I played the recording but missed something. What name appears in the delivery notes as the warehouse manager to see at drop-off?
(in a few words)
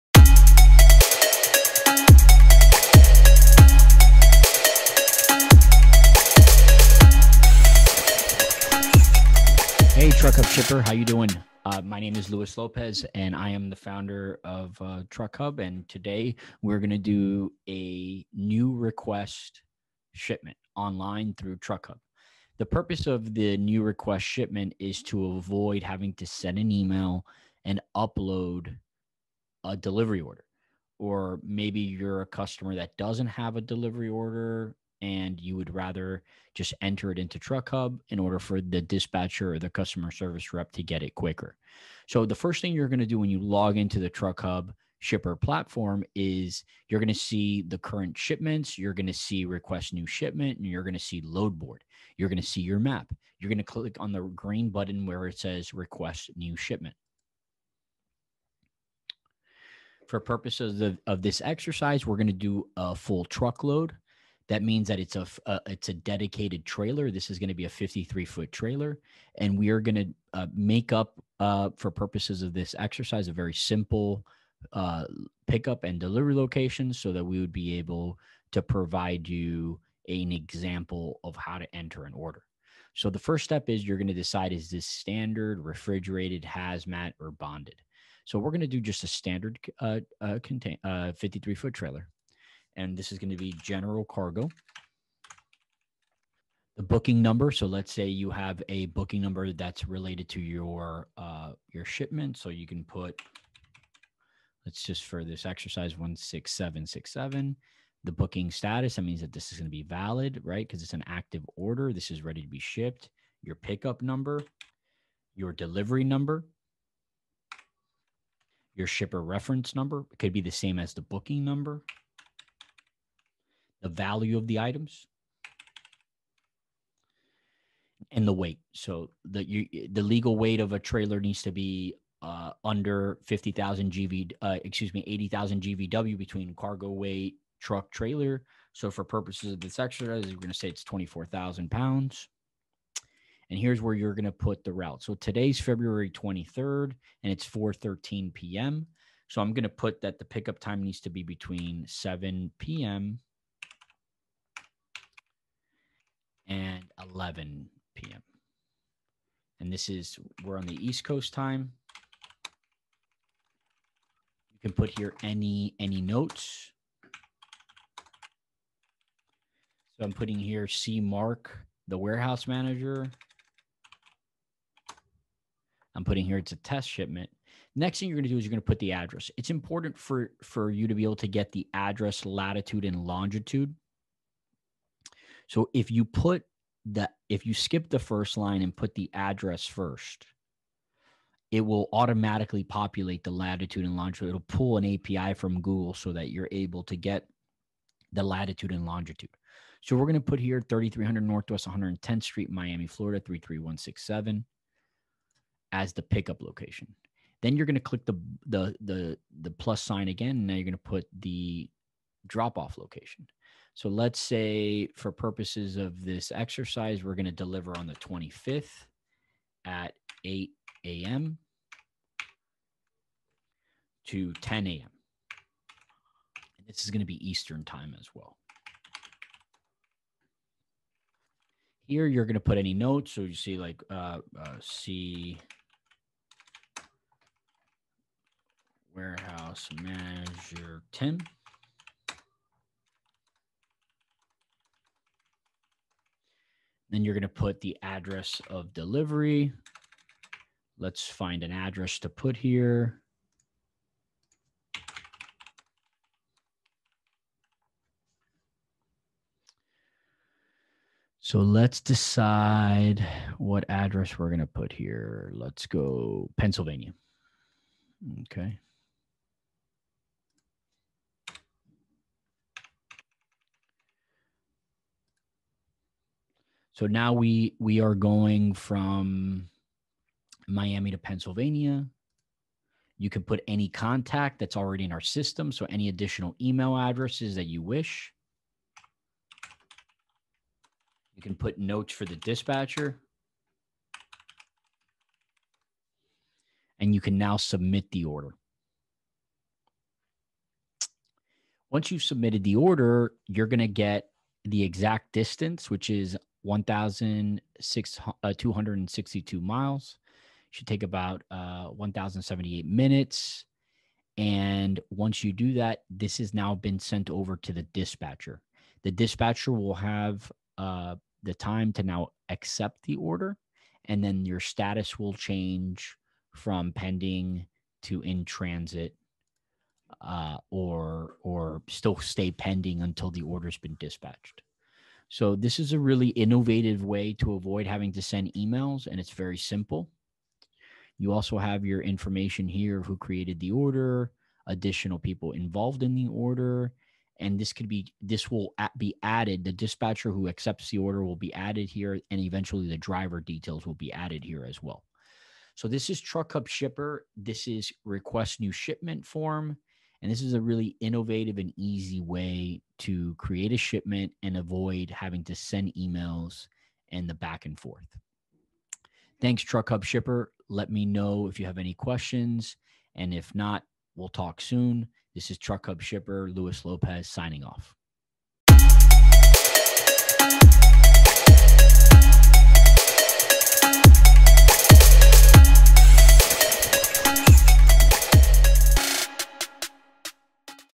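Tim.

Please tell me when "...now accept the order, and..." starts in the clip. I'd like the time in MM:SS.
05:21.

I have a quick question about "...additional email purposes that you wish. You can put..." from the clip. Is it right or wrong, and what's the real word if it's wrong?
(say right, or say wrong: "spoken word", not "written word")
wrong: "addresses", not "purposes".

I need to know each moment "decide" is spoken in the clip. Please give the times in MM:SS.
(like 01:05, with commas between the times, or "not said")
01:24, 04:21.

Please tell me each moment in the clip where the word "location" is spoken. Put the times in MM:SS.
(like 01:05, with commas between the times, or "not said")
01:16, 03:26, 03:32.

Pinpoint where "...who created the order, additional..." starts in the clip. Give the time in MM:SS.
05:42.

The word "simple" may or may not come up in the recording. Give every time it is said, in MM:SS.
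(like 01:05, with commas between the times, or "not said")
01:13, 05:39.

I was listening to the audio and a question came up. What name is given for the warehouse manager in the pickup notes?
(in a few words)
Mark.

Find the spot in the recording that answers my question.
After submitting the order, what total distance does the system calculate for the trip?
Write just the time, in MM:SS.
05:06.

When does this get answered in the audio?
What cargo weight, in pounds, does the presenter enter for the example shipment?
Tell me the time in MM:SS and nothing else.
02:20.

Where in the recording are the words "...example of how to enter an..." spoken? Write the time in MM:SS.
01:20.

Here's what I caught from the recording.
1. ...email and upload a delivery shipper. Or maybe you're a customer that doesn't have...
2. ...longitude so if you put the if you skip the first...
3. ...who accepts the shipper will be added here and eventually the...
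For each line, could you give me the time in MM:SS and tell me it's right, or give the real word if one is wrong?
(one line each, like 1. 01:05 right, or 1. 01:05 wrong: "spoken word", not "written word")
1. 00:26 wrong: "order", not "shipper"
2. 03:03 right
3. 05:50 wrong: "order", not "shipper".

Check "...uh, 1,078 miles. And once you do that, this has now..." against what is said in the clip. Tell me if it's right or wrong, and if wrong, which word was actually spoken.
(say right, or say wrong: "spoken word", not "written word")
wrong: "minutes", not "miles".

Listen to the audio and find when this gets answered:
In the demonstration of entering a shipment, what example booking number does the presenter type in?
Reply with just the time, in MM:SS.
01:45.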